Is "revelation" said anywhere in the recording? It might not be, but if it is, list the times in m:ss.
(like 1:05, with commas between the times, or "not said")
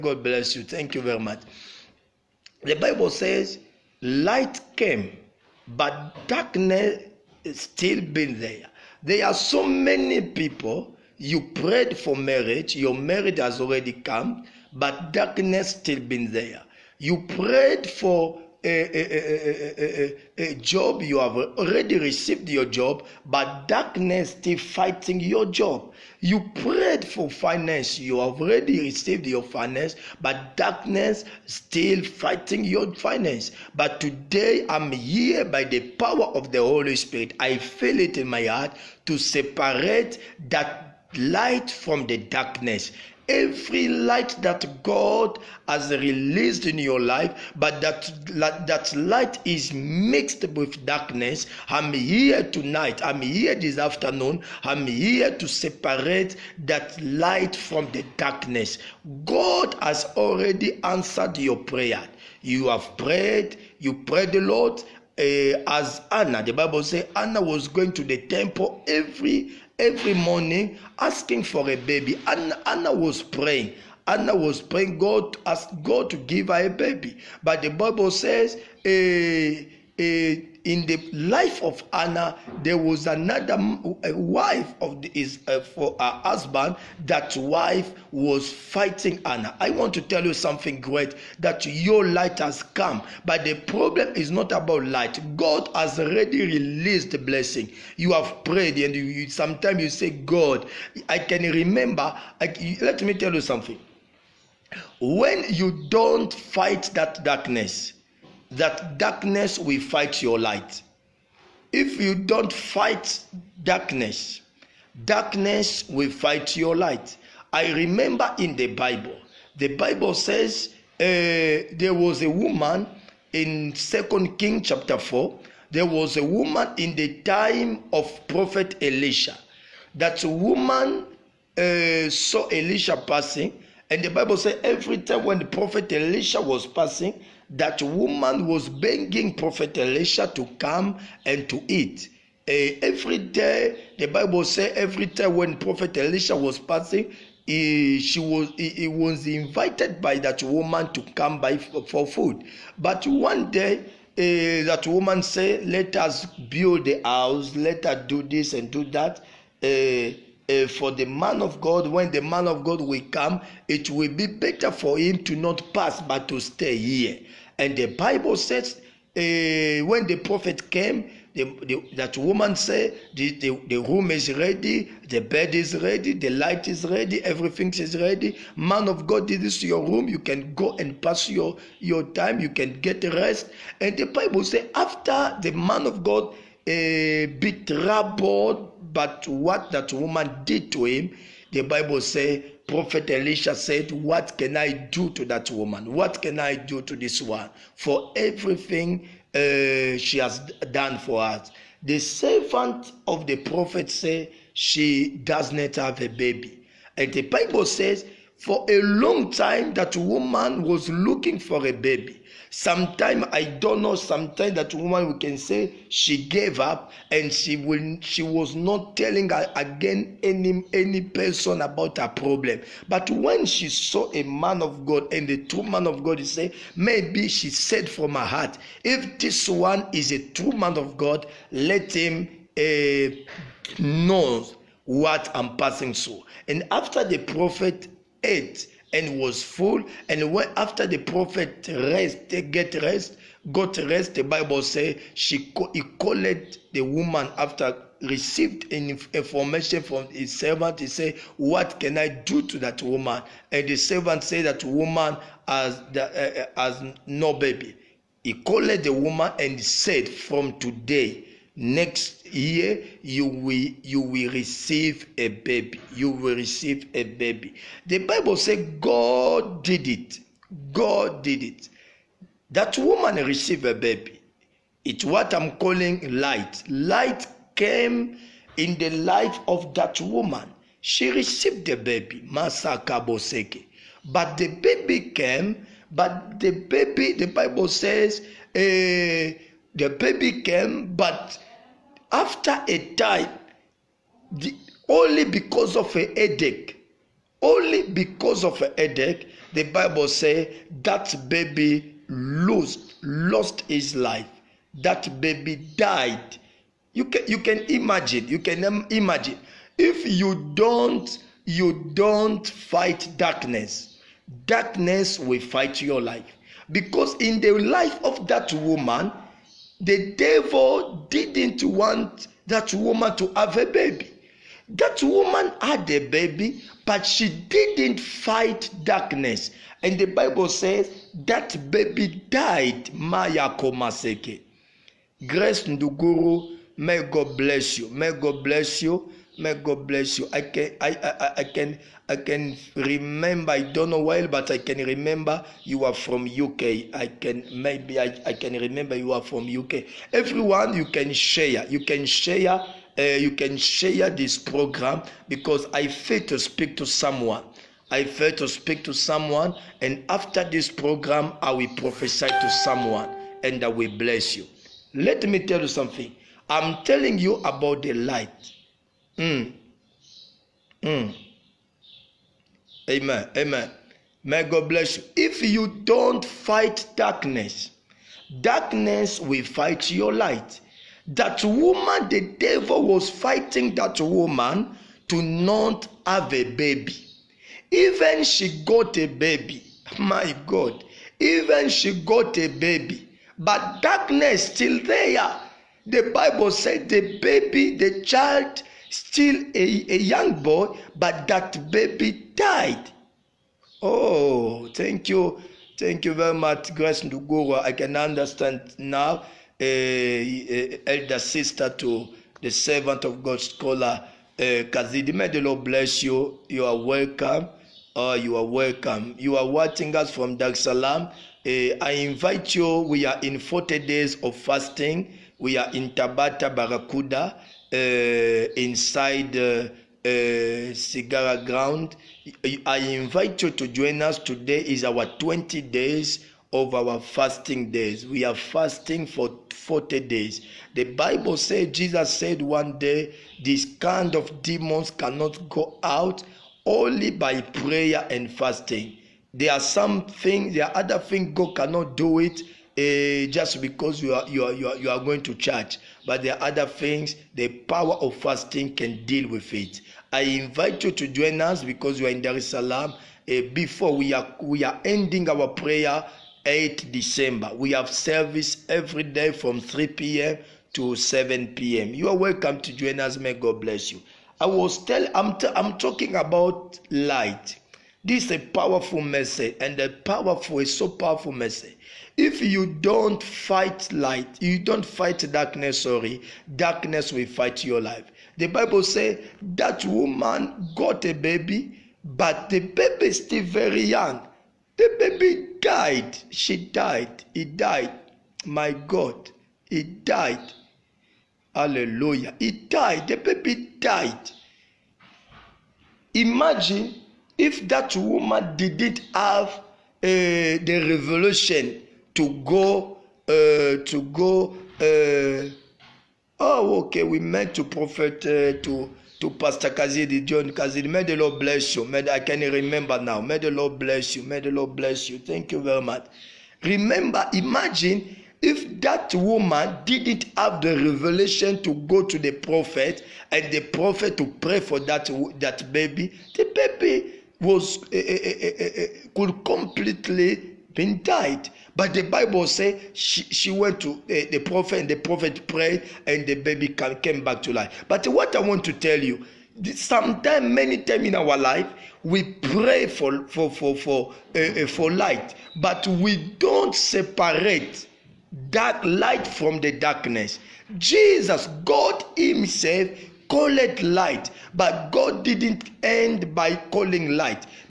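8:30, 8:50.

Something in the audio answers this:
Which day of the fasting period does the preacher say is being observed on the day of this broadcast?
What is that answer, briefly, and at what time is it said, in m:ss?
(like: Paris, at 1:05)
20th day, at 7:15.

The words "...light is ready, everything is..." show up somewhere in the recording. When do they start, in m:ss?
2:56.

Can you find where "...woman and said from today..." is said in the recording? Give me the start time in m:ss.
4:18.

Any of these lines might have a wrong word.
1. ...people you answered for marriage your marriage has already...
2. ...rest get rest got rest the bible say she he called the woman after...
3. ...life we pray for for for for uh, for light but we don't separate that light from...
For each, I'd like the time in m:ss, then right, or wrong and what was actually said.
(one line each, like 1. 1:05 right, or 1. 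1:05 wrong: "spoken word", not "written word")
1. 0:10 wrong: "prayed", not "answered"
2. 4:01 right
3. 9:11 right.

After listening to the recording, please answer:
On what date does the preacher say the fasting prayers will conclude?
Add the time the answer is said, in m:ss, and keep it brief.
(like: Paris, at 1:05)
8 December, at 7:46.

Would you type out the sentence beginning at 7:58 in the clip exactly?
This is a powerful mercy, and the powerful is so powerful mercy.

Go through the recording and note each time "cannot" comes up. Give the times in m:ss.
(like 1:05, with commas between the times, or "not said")
7:24, 7:31.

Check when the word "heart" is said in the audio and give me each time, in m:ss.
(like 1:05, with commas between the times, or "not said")
0:38, 3:48.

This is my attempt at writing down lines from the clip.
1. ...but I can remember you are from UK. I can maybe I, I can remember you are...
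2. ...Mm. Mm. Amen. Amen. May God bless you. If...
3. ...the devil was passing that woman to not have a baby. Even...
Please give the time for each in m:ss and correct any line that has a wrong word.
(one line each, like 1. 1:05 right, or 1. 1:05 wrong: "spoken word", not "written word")
1. 5:44 right
2. 6:09 right
3. 6:22 wrong: "fighting", not "passing".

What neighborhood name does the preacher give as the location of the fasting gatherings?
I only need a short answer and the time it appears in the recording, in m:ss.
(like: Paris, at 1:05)
Tabata Barakuda, at 7:05.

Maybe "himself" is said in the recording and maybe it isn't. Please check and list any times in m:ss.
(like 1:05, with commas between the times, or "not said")
9:22.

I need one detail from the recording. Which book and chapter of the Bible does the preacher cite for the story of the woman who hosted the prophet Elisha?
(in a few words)
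Second Kings chapter 4.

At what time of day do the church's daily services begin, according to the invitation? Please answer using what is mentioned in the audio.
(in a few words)
3 p.m.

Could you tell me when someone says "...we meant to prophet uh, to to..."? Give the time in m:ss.
8:37.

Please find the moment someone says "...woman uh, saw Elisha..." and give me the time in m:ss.
2:10.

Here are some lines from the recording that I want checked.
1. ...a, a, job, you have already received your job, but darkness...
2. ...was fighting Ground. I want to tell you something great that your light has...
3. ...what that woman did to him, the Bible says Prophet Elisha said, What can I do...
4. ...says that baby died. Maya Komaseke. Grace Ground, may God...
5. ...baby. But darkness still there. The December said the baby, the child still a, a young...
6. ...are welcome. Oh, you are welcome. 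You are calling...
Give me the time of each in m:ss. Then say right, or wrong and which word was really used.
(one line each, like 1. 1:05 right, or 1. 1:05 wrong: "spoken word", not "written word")
1. 0:19 right
2. 1:28 wrong: "Anna", not "Ground"
3. 3:09 right
4. 5:30 wrong: "Nduguru", not "Ground"
5. 6:32 wrong: "Bible", not "December"
6. 6:56 wrong: "watching", not "calling".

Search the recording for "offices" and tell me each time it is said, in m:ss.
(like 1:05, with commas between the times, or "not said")
not said.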